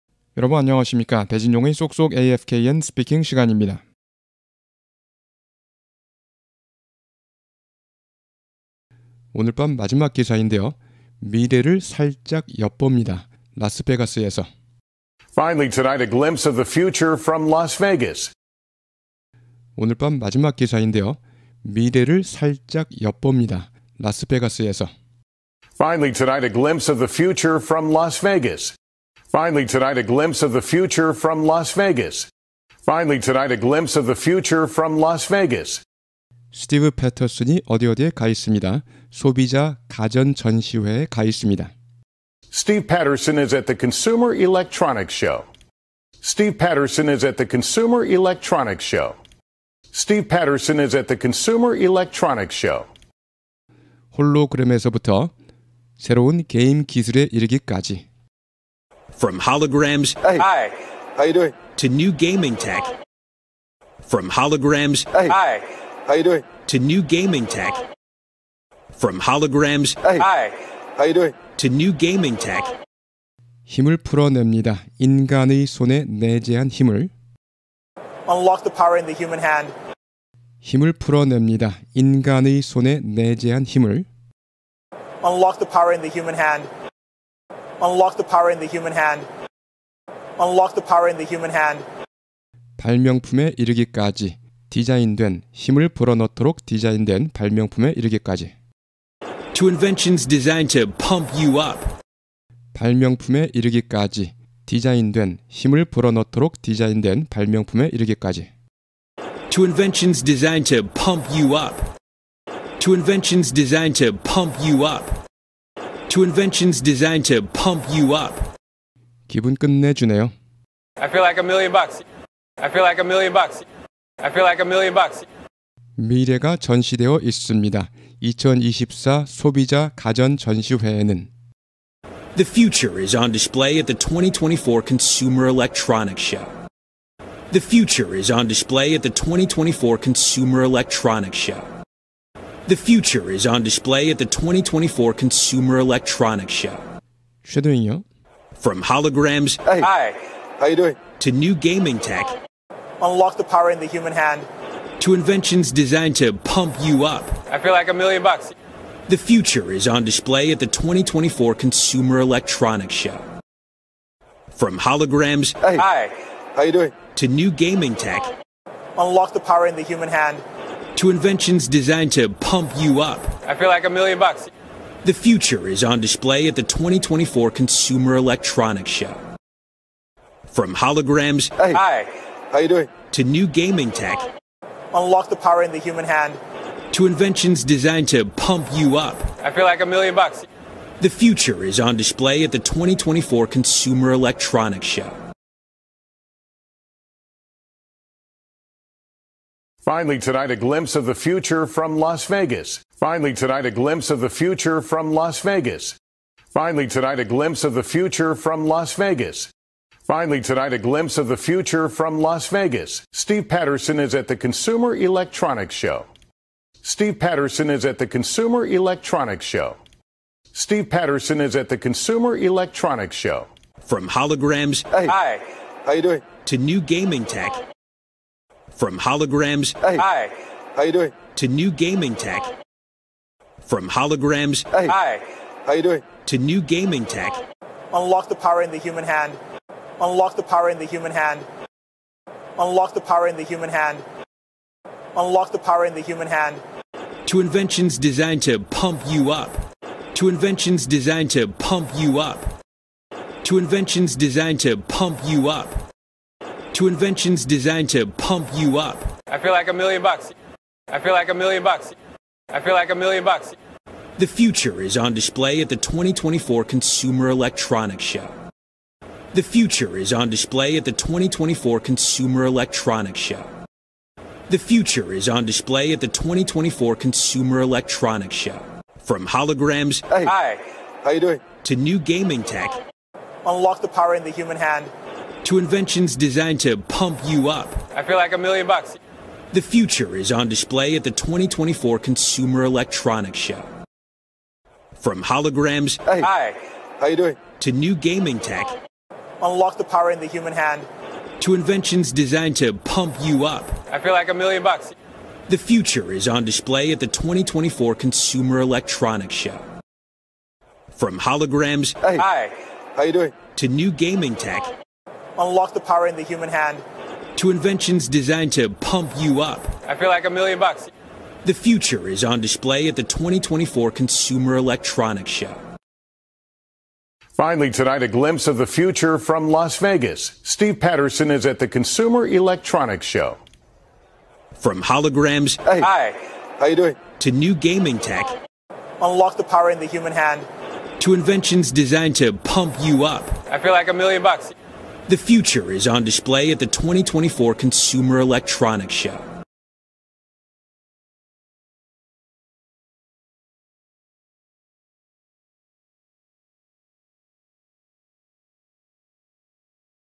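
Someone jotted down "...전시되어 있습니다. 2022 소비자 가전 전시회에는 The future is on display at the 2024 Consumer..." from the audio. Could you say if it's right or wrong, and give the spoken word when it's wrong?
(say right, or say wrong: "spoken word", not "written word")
wrong: "2024", not "2022".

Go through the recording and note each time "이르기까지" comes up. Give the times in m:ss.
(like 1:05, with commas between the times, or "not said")
0:57, 1:33, 1:37, 1:43, 1:47.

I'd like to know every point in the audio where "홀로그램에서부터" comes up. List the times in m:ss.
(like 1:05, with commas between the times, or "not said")
0:54.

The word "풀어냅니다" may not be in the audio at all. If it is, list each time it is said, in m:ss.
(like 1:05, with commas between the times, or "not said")
1:13, 1:20.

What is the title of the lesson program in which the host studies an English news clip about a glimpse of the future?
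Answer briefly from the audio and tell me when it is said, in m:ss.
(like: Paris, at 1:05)
쏙쏙 AFKN 스피킹, at 0:01.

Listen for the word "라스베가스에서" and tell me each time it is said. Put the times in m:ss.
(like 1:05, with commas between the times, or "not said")
0:13, 0:23.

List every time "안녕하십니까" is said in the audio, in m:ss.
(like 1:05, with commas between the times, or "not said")
0:00.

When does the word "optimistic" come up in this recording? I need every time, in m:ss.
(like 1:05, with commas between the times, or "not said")
not said.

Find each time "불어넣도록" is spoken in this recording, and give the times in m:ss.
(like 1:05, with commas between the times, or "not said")
1:35, 1:45.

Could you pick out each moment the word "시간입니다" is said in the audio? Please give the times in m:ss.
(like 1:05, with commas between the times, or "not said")
0:03.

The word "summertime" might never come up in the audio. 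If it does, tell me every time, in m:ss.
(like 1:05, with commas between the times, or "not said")
not said.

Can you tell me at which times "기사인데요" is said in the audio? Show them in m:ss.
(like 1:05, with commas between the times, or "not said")
0:10, 0:20.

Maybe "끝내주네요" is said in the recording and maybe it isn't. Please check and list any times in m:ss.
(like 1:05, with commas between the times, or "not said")
1:59.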